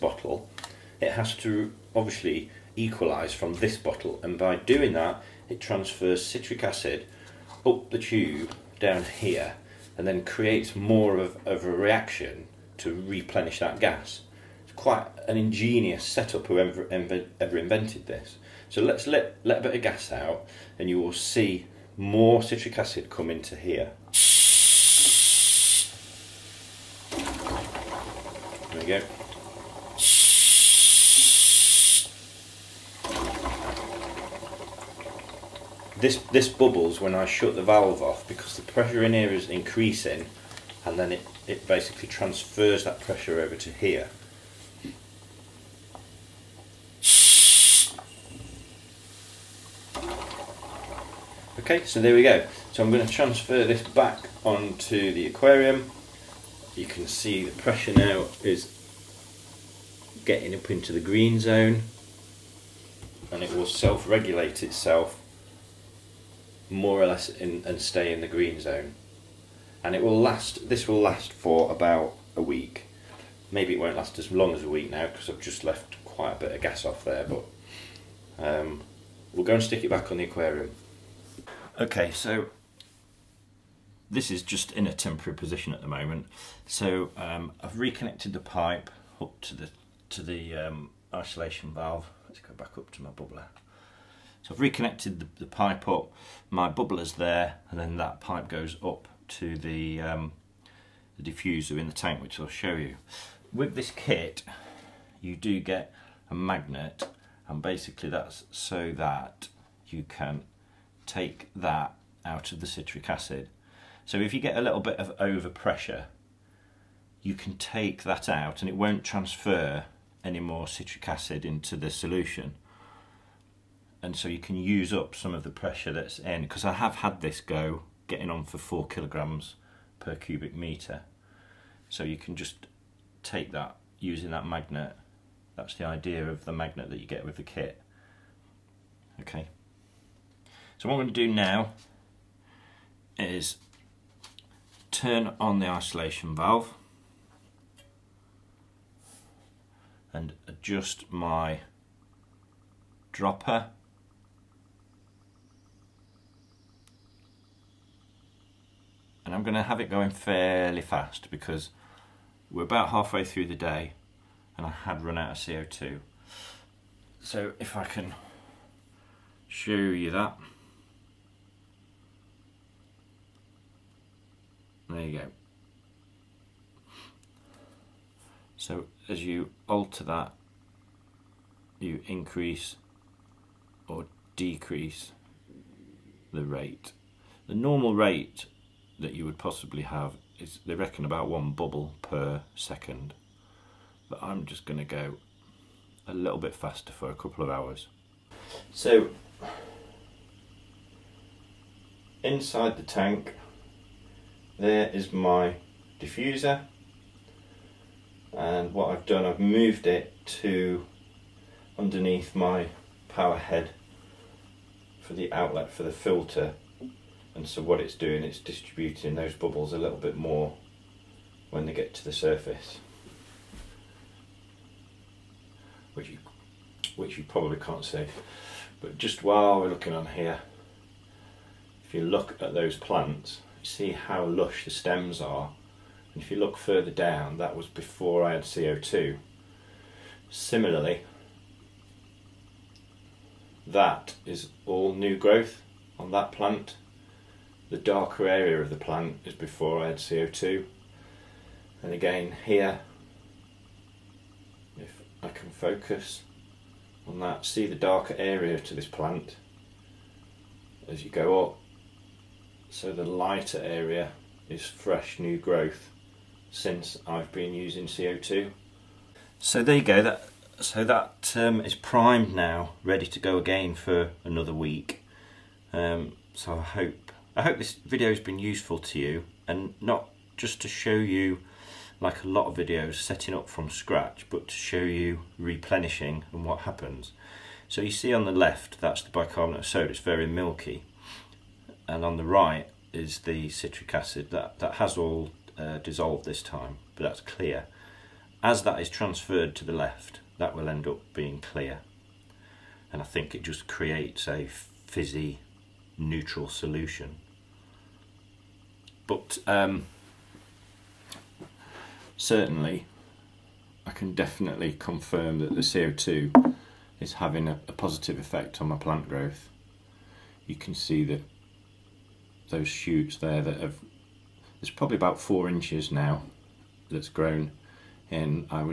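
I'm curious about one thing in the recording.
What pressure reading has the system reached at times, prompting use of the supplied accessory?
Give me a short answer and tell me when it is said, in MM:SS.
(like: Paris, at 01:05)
4 kilograms per cubic meter, at 02:08.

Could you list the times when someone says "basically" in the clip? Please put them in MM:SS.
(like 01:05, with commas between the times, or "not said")
00:41, 01:47.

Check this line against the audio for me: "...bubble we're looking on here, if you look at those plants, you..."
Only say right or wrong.
wrong.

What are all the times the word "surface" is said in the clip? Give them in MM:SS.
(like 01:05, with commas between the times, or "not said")
03:42.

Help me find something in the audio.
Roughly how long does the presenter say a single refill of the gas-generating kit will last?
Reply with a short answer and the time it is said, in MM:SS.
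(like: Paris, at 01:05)
about a week, at 01:11.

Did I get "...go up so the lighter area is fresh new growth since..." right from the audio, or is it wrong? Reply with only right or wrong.
right.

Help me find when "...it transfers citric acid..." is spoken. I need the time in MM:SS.
00:05.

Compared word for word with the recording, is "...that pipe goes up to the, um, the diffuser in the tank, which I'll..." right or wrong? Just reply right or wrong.
right.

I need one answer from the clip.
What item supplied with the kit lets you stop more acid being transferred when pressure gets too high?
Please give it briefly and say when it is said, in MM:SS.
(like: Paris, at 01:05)
a magnet, at 01:46.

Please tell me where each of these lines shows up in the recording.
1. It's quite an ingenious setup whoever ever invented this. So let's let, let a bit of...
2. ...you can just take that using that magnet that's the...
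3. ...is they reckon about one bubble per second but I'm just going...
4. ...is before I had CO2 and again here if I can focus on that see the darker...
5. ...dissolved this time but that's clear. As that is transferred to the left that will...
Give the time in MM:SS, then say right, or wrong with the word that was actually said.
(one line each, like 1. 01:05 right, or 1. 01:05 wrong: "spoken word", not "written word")
1. 00:14 right
2. 02:12 right
3. 03:10 right
4. 04:09 right
5. 04:55 right.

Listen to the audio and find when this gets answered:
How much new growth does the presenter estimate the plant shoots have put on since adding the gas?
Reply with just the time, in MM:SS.
05:24.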